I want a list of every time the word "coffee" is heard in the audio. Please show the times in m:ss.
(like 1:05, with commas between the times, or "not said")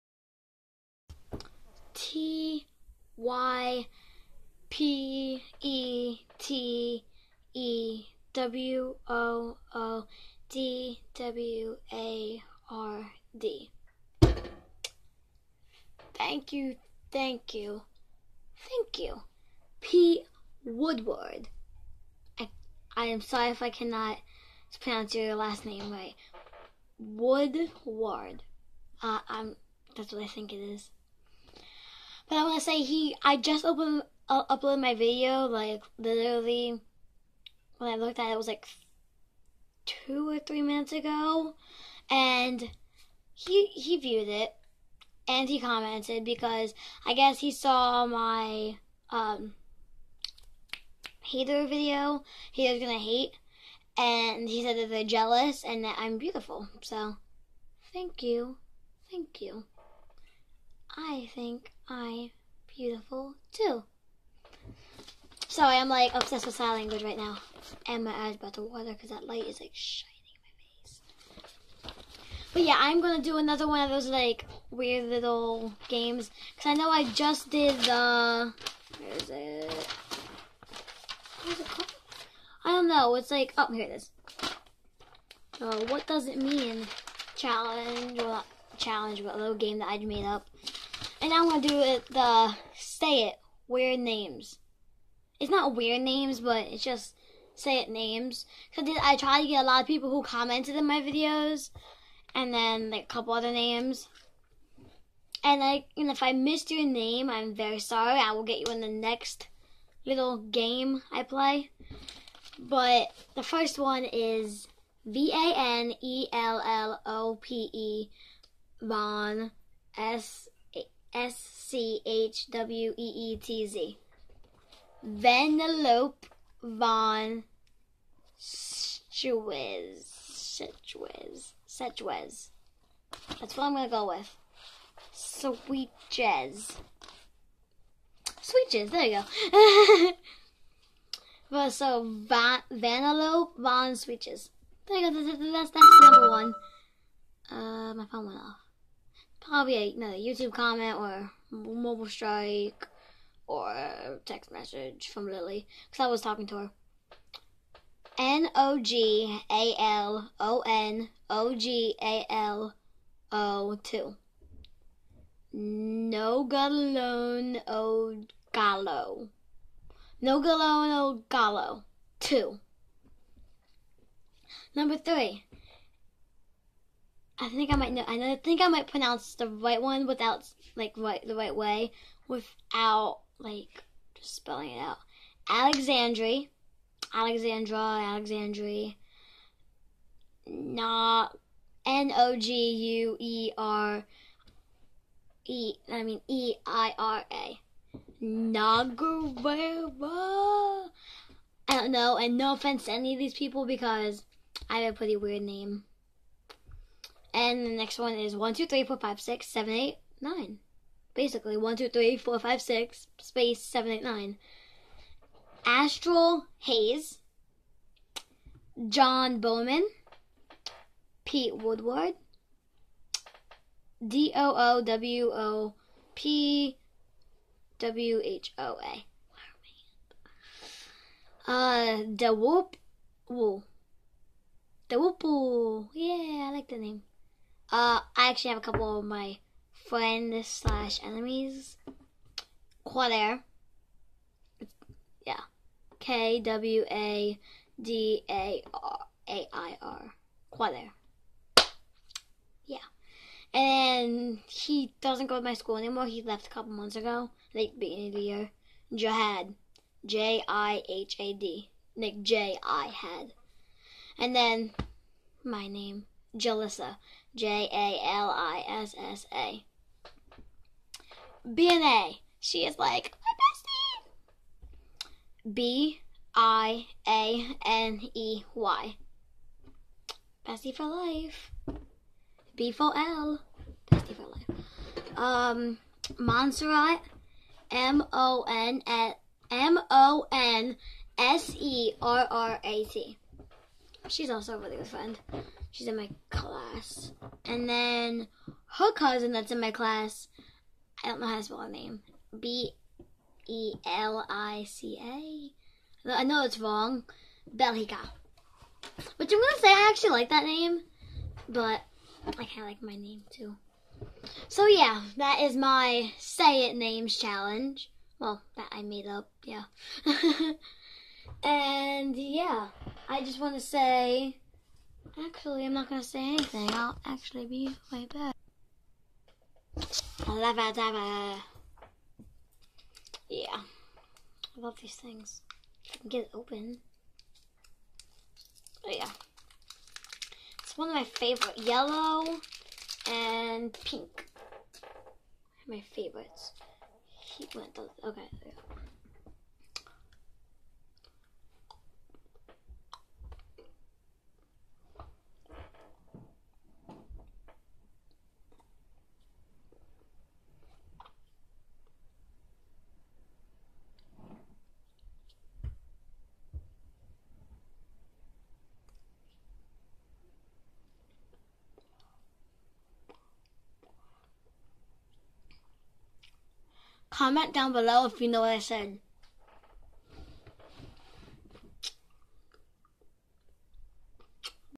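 not said.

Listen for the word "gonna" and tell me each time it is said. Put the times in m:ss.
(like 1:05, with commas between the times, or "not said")
0:52, 1:31, 5:09.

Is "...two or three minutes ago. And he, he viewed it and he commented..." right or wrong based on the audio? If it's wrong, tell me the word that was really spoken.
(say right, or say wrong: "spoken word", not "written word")
right.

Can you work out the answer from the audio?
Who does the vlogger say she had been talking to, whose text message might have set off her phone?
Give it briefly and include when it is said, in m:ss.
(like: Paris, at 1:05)
Lily, at 2:35.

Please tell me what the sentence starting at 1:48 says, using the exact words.
I will get you in the next little game I play.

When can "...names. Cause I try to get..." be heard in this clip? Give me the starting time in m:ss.
1:37.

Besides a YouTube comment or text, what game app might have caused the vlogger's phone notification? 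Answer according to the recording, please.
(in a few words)
Mobile Strike.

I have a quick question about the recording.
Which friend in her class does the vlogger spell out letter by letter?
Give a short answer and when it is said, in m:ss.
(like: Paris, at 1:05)
Montserrat, at 4:46.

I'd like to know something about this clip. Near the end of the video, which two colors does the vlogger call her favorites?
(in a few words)
Yellow and pink.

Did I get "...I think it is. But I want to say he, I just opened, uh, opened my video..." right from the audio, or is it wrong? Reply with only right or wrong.
wrong.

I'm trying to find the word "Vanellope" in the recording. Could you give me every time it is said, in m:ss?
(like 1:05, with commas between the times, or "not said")
2:05, 2:22.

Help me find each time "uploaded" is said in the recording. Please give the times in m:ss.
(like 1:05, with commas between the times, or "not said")
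0:34.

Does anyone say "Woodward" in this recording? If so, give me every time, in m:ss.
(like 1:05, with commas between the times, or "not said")
0:20, 0:26, 3:41.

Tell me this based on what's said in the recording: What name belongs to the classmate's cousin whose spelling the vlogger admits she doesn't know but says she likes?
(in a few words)
Belica.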